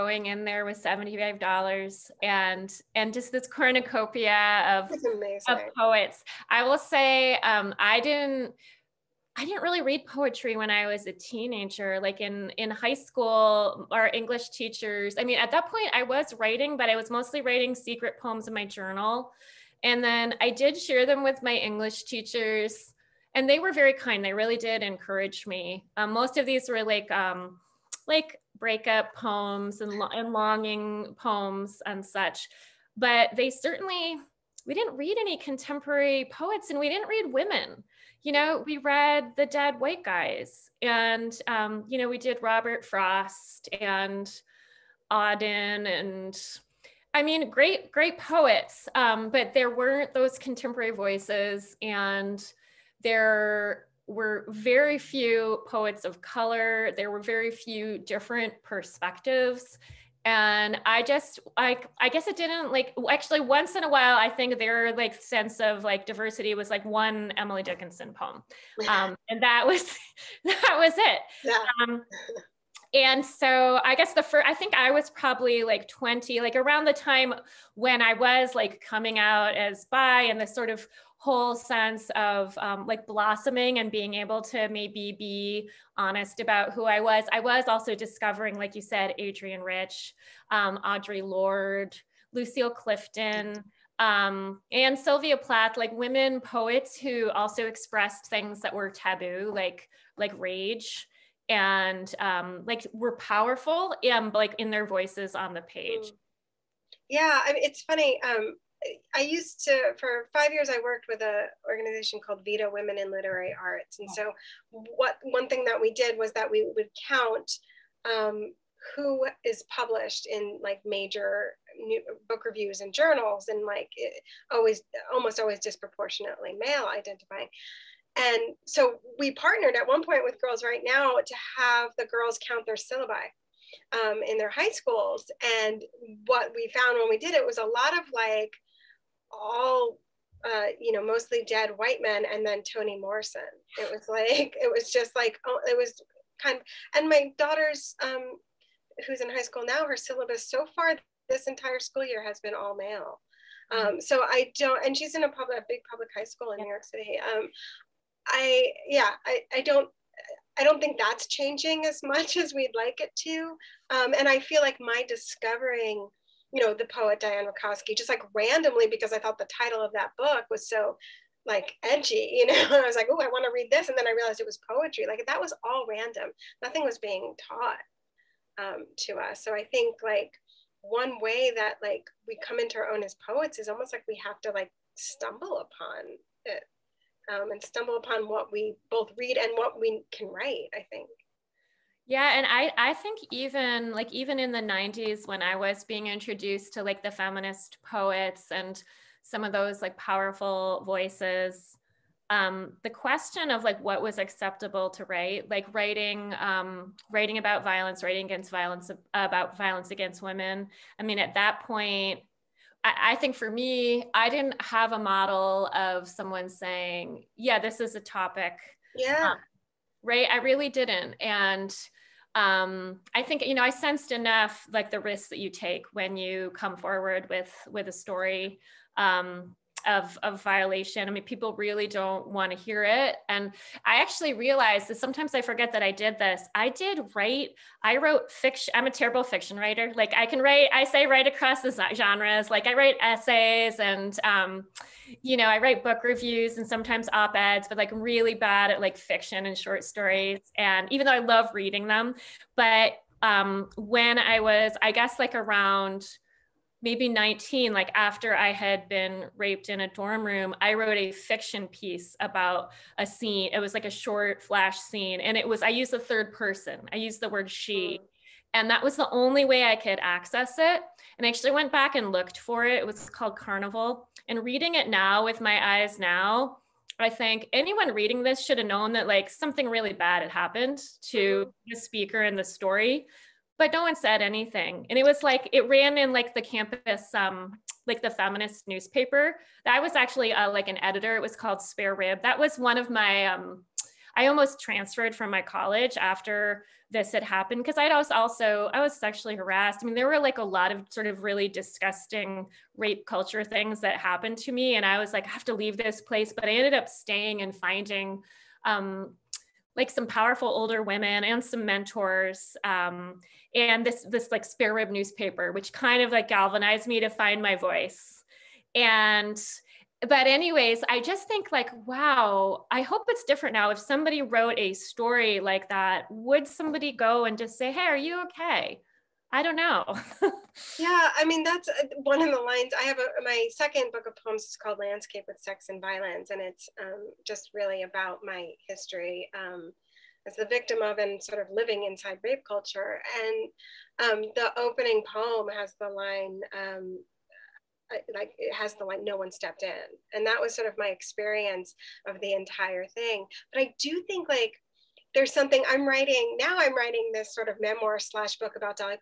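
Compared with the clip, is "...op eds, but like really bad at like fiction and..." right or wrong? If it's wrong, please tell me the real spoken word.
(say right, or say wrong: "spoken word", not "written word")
right.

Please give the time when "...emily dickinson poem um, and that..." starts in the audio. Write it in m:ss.
1:07.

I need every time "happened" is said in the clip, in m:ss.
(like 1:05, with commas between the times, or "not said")
4:40, 4:57, 5:03.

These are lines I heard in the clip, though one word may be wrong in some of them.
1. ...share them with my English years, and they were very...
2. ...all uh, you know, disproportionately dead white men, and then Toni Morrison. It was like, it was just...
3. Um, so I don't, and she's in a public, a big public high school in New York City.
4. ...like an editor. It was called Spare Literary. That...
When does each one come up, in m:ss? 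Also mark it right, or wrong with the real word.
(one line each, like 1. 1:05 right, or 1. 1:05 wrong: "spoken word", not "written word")
1. 0:20 wrong: "teachers", not "years"
2. 2:19 wrong: "mostly", not "disproportionately"
3. 2:33 right
4. 4:50 wrong: "Rib", not "Literary".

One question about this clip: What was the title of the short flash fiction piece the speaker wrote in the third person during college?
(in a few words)
Carnival.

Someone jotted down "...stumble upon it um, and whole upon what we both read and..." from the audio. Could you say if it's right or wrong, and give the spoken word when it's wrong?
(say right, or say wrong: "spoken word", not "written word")
wrong: "stumble", not "whole".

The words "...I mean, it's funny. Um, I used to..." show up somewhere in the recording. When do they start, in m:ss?
1:47.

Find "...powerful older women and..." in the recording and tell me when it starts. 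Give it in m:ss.
5:10.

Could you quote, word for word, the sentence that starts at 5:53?
But I do think like there's something I'm writing now.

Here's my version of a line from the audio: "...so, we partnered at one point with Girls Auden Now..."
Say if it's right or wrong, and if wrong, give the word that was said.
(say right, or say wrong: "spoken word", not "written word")
wrong: "Write", not "Auden".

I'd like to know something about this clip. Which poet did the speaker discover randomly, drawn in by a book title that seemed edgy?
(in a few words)
Diane Wakoski.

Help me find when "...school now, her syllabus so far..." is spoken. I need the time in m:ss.
2:29.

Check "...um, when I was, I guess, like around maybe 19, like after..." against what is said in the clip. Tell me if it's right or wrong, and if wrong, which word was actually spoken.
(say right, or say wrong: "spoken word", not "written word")
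right.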